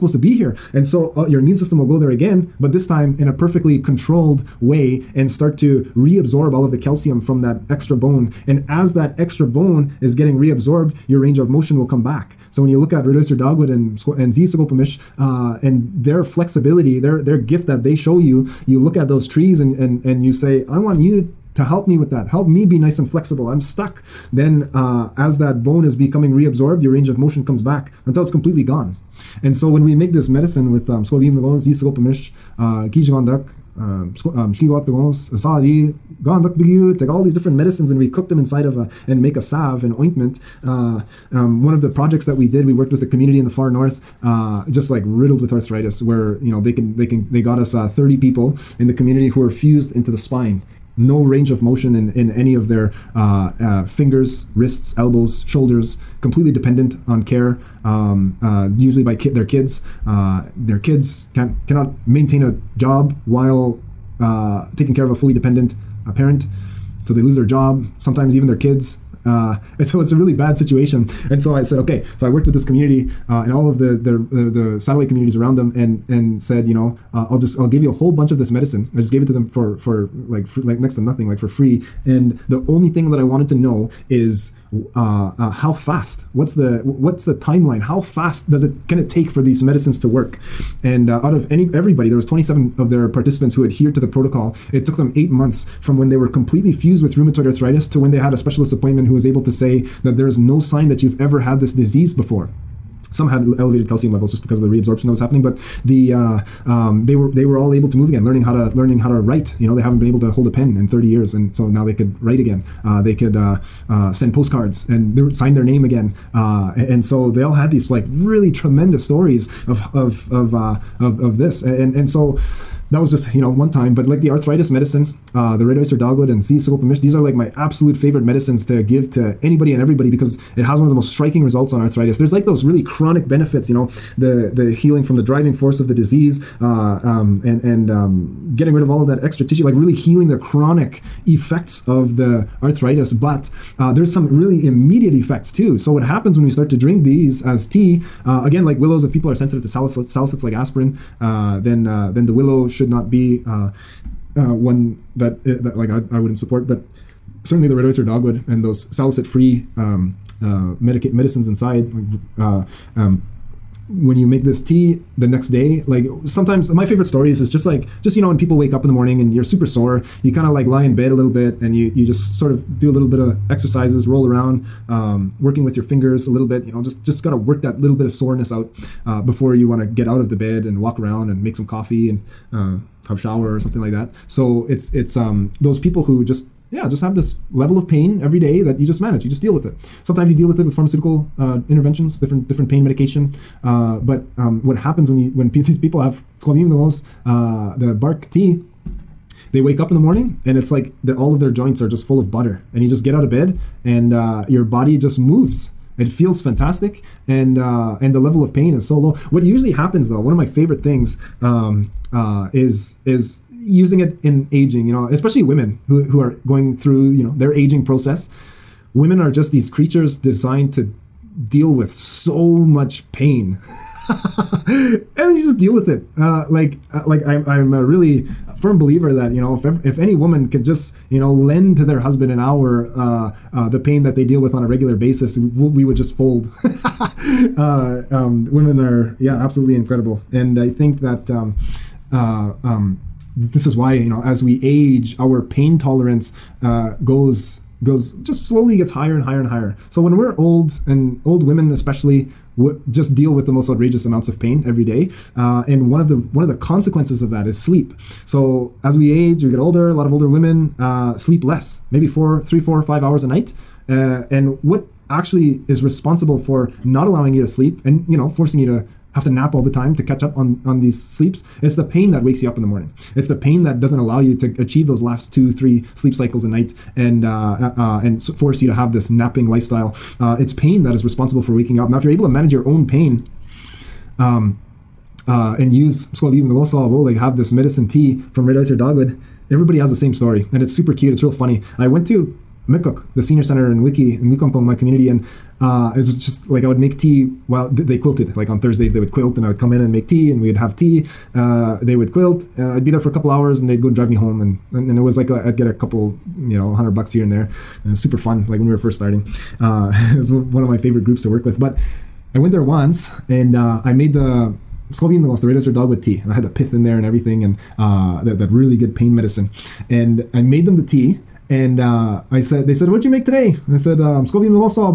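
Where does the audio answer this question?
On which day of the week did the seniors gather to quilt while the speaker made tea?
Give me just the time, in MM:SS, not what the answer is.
04:58.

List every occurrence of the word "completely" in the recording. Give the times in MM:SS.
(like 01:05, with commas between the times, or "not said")
00:28, 00:56, 01:36.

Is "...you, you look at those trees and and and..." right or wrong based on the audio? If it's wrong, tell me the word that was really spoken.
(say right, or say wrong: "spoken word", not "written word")
right.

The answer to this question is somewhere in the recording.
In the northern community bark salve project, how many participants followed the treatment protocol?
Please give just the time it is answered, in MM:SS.
01:32.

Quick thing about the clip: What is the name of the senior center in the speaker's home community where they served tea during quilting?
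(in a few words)
Mikok.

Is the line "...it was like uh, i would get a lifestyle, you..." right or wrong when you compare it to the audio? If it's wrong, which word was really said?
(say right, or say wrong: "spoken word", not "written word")
wrong: "couple", not "lifestyle".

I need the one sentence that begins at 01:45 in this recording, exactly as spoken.
But the uh, um, they were they were all able to move again, learning how to learning how to write.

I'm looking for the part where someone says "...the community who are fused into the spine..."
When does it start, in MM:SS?
00:48.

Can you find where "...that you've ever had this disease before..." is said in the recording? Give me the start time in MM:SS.
01:40.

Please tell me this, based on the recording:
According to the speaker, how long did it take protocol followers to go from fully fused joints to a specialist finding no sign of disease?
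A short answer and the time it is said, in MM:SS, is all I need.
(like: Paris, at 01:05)
Eight months, at 01:35.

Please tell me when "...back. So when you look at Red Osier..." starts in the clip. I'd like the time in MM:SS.
00:12.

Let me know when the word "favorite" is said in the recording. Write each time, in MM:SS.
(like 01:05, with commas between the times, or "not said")
02:07, 02:46, 03:30, 05:10.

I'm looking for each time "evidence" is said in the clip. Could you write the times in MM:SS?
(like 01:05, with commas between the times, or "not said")
not said.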